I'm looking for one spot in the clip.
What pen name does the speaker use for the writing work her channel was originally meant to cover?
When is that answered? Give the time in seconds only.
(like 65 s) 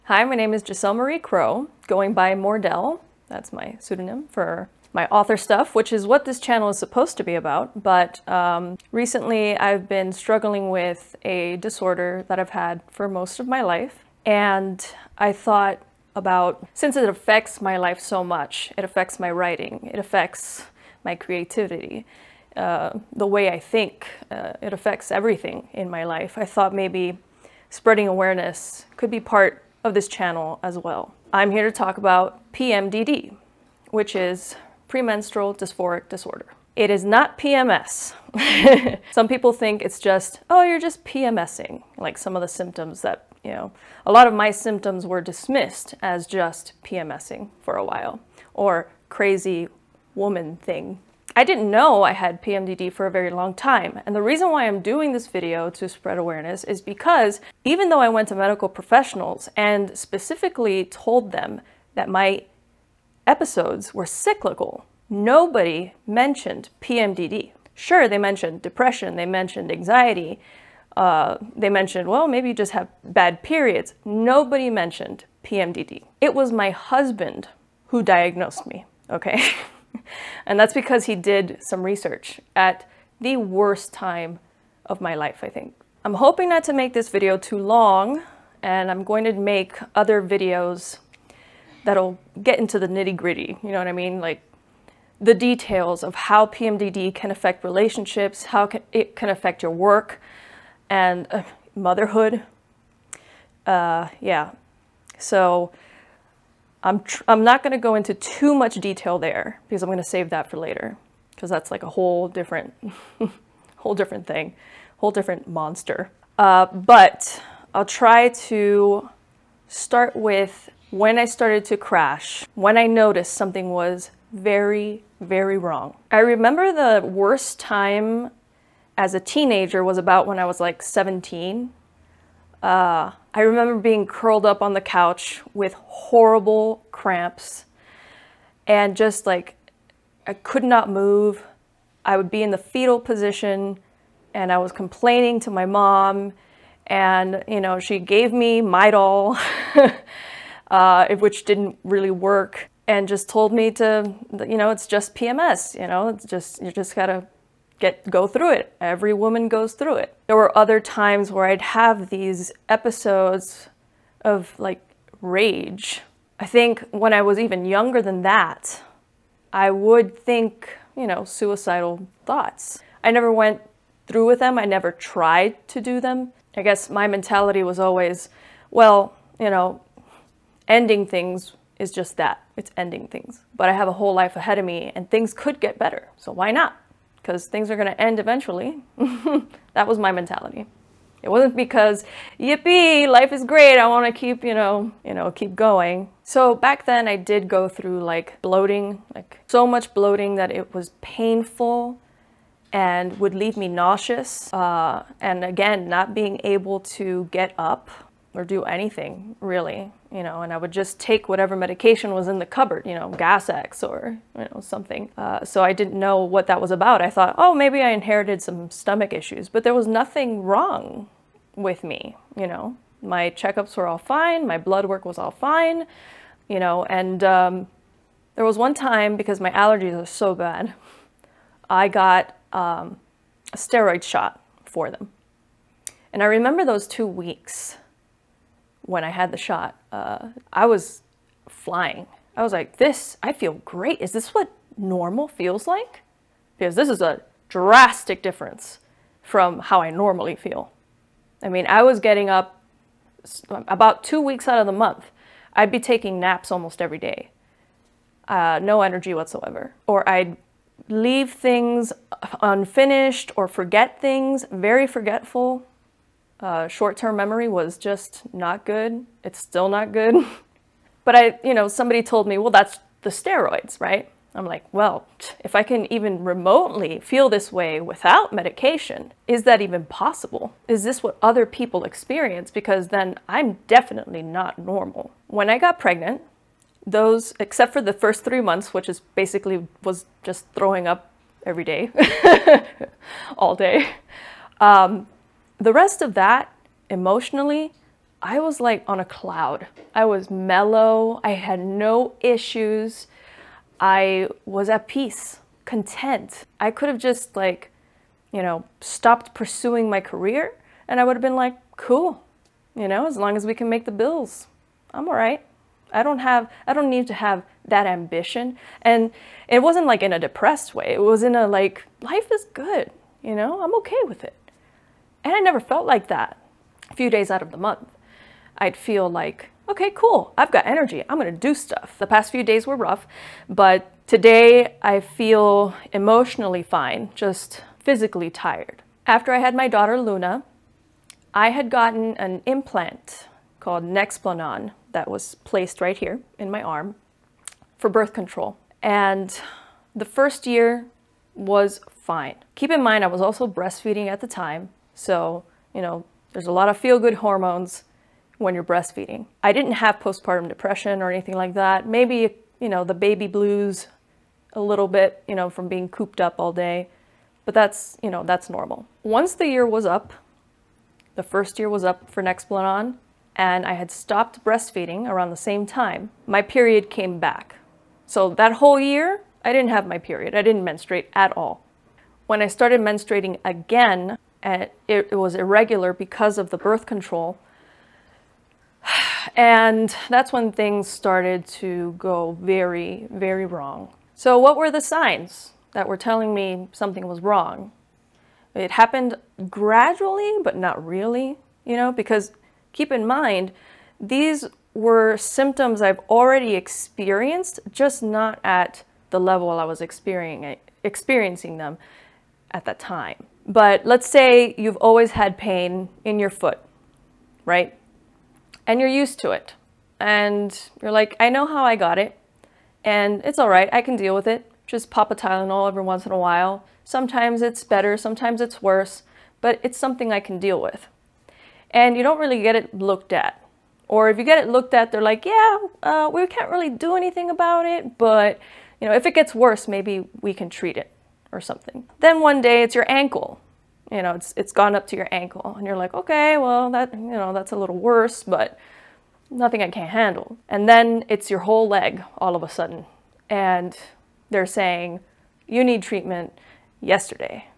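2 s.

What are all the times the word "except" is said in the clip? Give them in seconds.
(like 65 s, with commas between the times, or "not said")
287 s.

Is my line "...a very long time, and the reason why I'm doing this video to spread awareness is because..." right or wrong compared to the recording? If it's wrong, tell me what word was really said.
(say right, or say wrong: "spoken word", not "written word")
right.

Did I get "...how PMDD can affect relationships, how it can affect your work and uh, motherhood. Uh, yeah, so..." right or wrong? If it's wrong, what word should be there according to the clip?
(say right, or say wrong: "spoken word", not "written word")
right.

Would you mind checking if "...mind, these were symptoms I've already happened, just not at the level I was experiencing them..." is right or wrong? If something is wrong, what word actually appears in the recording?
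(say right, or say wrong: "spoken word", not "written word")
wrong: "experienced", not "happened".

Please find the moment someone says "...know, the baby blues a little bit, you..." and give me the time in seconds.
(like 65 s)
362 s.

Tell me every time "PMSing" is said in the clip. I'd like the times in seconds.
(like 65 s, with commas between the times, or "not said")
41 s, 46 s.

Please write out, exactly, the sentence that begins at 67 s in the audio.
Sure, they mentioned depression, they mentioned anxiety, uh, they mentioned, well, maybe you just have bad periods.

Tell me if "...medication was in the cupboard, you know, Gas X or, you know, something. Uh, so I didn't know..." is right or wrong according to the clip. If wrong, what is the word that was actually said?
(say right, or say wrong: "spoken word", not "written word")
right.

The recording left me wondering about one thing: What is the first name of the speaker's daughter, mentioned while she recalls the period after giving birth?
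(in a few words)
Luna.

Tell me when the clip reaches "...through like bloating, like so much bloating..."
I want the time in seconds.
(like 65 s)
197 s.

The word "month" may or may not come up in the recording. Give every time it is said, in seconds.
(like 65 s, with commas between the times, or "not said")
254 s, 288 s, 327 s.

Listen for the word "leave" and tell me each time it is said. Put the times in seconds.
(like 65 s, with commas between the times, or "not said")
203 s, 260 s.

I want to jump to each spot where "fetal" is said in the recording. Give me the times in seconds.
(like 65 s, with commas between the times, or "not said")
142 s.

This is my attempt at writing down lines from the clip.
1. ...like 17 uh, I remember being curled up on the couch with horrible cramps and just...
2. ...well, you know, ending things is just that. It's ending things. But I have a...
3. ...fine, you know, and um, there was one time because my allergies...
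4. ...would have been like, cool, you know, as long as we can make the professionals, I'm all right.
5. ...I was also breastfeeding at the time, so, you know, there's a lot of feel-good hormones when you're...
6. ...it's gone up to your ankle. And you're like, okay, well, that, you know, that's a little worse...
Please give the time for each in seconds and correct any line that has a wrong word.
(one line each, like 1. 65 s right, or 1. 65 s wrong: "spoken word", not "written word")
1. 130 s right
2. 178 s right
3. 225 s right
4. 311 s wrong: "bills", not "professionals"
5. 353 s right
6. 444 s right.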